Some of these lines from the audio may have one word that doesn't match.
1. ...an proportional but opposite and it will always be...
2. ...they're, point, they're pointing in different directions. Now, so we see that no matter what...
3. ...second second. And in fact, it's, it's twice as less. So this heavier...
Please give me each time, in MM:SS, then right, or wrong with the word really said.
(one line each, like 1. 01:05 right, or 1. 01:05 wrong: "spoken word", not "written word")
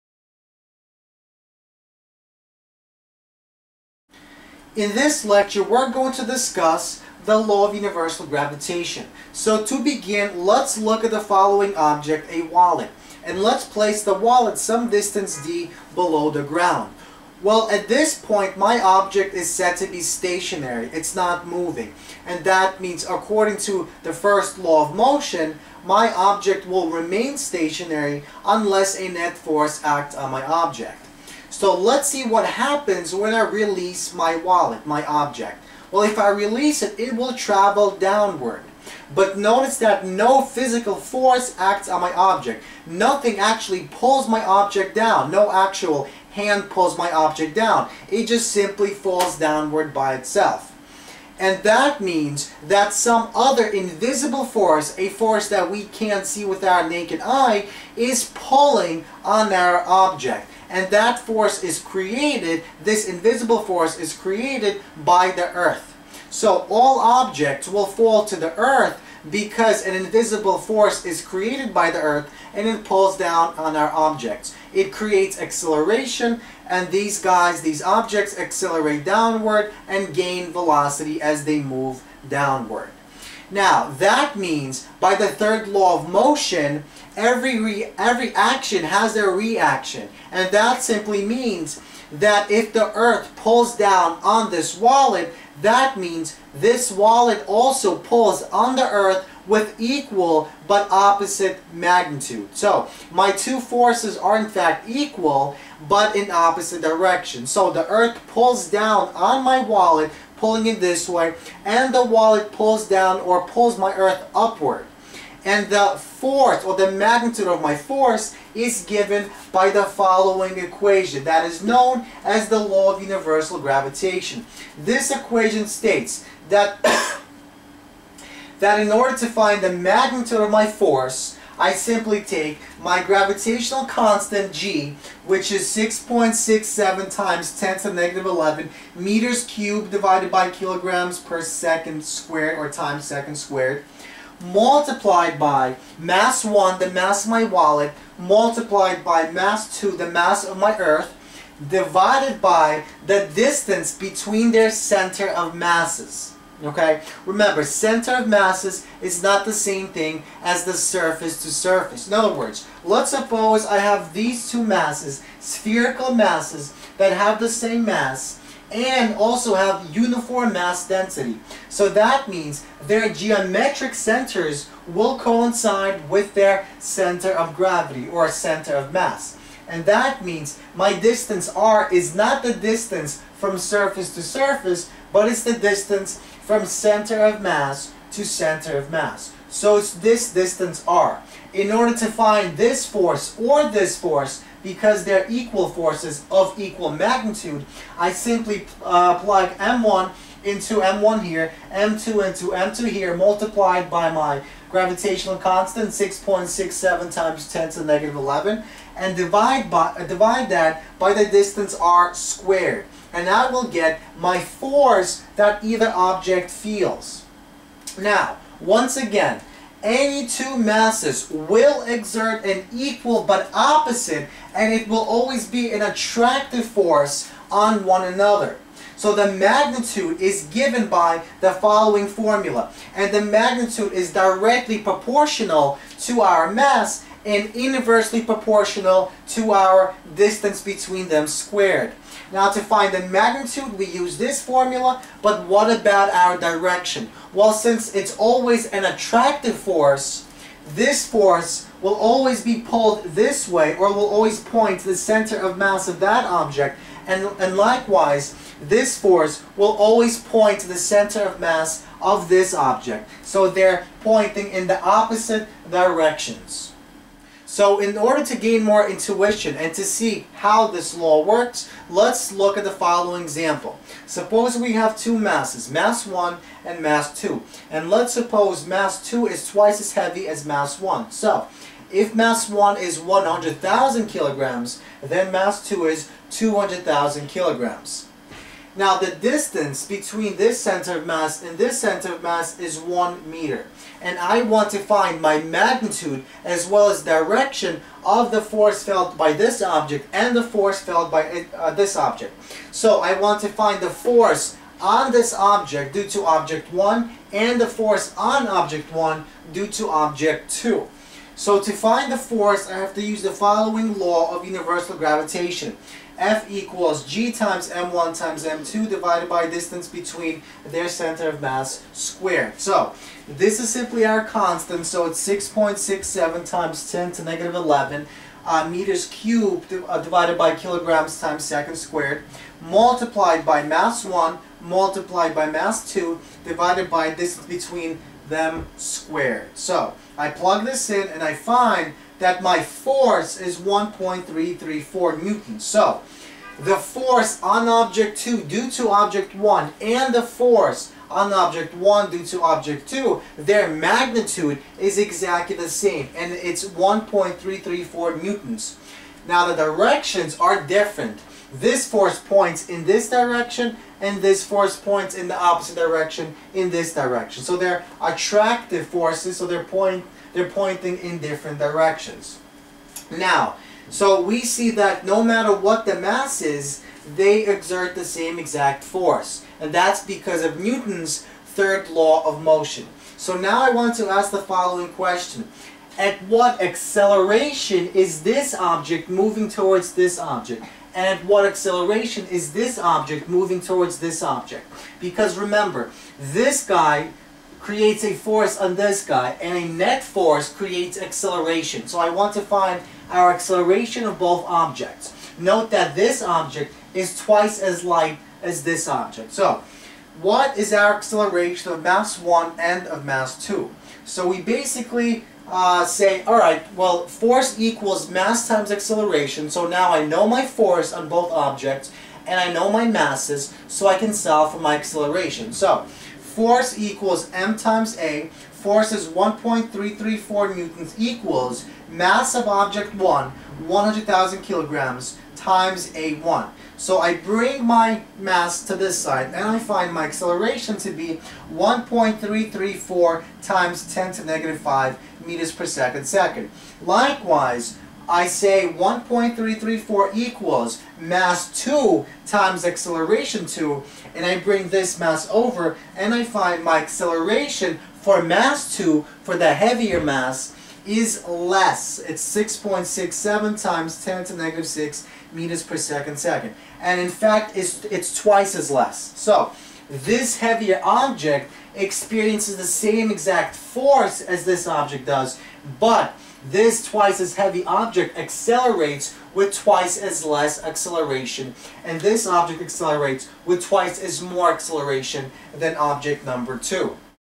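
1. 03:42 wrong: "equal", not "proportional"
2. 06:09 right
3. 07:45 right.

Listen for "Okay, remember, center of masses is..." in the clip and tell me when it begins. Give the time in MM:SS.
02:36.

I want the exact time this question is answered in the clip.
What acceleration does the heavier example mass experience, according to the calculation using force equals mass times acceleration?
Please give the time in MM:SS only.
07:42.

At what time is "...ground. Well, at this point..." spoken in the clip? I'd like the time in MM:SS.
00:16.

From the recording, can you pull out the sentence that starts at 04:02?
Now to find the magnitude, we use this formula, but what about our direction?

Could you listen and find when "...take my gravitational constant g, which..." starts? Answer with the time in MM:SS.
02:12.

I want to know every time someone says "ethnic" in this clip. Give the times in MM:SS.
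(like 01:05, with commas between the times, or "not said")
not said.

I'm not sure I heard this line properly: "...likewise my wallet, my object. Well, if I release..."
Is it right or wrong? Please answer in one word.
wrong.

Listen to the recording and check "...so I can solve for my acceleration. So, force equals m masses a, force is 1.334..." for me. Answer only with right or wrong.
wrong.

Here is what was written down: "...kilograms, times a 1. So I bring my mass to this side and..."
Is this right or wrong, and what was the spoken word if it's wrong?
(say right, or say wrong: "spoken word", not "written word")
right.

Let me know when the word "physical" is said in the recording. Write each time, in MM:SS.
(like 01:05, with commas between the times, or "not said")
00:40.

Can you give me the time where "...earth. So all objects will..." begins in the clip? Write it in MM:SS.
01:05.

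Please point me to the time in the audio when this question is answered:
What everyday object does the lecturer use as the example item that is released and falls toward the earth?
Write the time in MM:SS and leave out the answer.
00:12.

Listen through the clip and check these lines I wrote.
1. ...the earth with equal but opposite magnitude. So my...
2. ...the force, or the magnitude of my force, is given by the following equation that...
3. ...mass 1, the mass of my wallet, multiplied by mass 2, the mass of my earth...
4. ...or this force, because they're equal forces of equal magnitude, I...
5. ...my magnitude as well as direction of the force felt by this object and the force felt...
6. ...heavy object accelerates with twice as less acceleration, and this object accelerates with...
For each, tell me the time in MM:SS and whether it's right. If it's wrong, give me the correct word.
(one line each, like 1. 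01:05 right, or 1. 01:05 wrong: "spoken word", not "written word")
1. 01:38 right
2. 01:55 right
3. 02:25 right
4. 03:13 right
5. 04:55 right
6. 07:57 right.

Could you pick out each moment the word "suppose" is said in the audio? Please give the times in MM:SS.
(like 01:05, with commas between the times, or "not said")
02:43, 04:34, 04:38.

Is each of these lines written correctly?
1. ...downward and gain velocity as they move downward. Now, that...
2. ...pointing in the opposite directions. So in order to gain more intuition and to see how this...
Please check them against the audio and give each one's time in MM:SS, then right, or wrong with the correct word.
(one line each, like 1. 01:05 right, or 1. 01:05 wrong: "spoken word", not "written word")
1. 01:19 right
2. 04:24 right.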